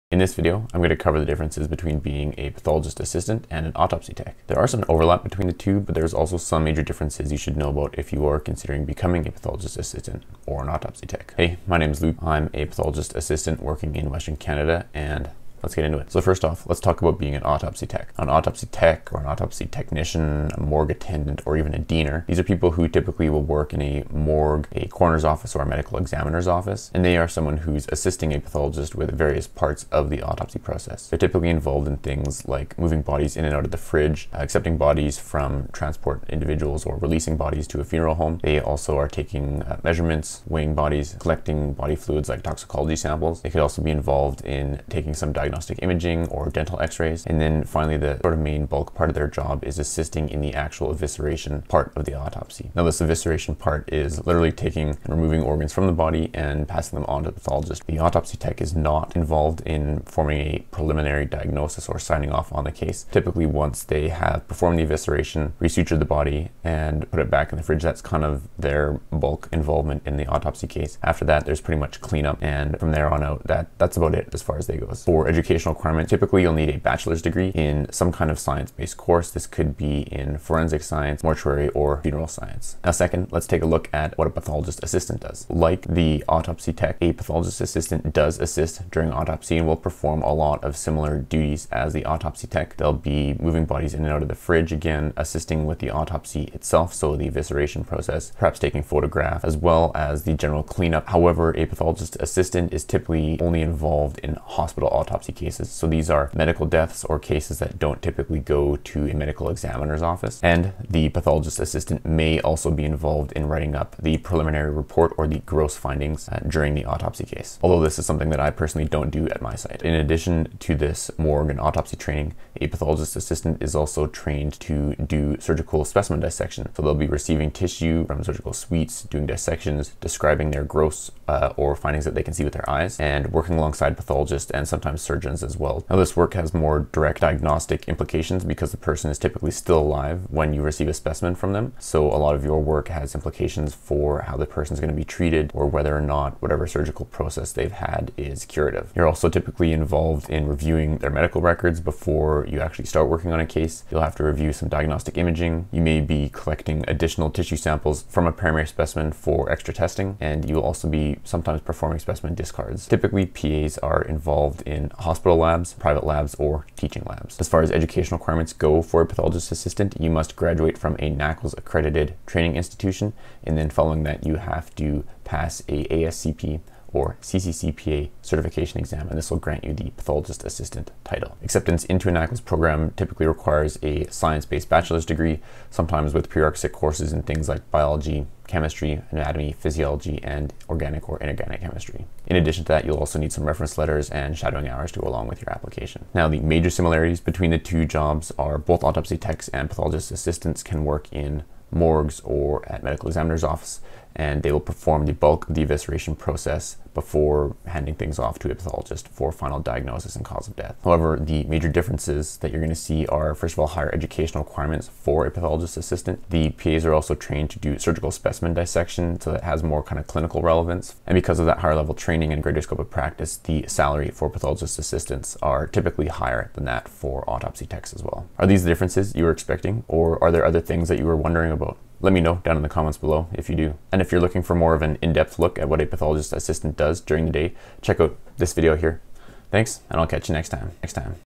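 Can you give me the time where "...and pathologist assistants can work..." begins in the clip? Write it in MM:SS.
03:19.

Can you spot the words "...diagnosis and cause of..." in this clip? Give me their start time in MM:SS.
03:29.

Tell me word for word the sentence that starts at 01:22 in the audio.
Now second, let's take a look at what a pathologist assistant does.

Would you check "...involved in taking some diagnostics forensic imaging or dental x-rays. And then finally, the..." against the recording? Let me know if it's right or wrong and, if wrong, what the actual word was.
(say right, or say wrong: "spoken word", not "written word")
wrong: "diagnostic", not "forensic".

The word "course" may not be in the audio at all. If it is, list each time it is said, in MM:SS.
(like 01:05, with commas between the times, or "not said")
01:18, 03:06.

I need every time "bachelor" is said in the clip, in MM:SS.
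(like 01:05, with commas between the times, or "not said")
01:16, 03:04.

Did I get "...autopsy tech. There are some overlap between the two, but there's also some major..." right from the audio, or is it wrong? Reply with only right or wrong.
right.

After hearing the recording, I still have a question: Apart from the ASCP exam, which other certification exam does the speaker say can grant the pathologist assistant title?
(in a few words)
CCCPA.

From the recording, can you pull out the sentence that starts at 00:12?
I'm a pathologist assistant working in Western Canada, and Let's get into it.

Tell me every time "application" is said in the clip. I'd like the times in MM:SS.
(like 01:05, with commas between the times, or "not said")
03:15.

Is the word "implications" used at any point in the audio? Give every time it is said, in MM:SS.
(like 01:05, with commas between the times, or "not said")
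02:17, 02:23.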